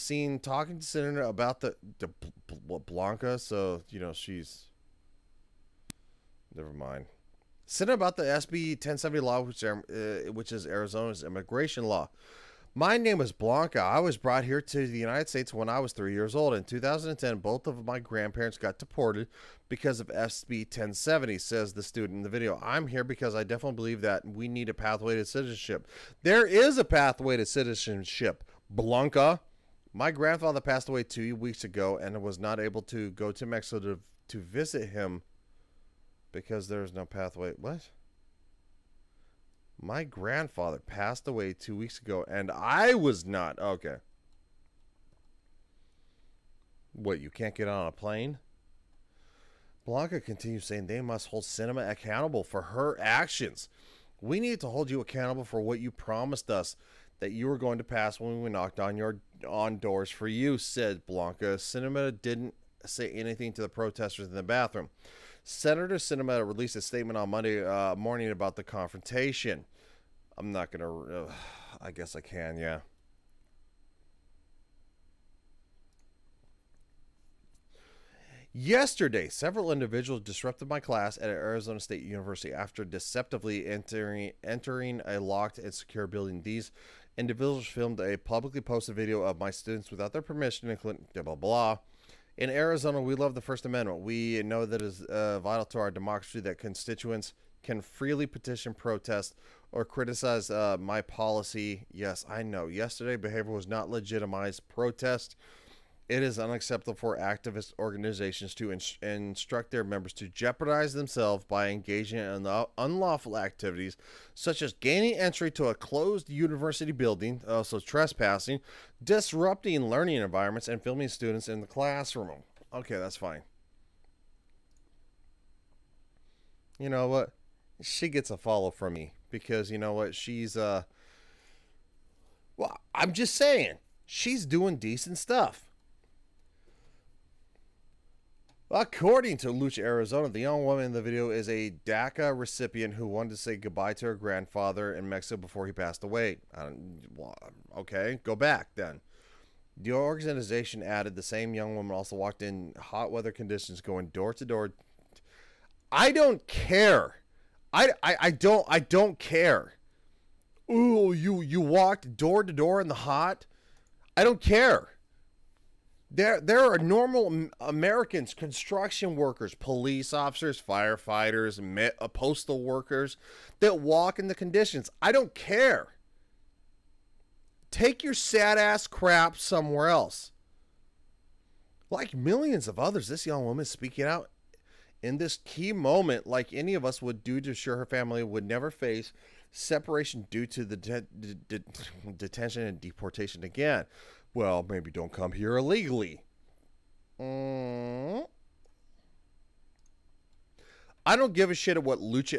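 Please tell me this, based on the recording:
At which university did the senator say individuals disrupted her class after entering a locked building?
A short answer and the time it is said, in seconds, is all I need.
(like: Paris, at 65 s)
Arizona State University, at 81 s.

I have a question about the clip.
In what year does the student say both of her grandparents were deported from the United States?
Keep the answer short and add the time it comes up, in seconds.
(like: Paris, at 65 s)
2010, at 16 s.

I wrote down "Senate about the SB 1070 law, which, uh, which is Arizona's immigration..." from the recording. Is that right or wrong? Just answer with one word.
right.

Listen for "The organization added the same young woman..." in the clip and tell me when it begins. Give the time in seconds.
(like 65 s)
149 s.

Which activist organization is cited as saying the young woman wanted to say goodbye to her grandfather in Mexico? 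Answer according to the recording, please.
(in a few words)
Lucha Arizona.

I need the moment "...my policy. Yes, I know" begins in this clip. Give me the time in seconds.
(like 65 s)
100 s.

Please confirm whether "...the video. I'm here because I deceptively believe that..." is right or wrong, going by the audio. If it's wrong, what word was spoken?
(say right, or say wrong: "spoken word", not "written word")
wrong: "definitely", not "deceptively".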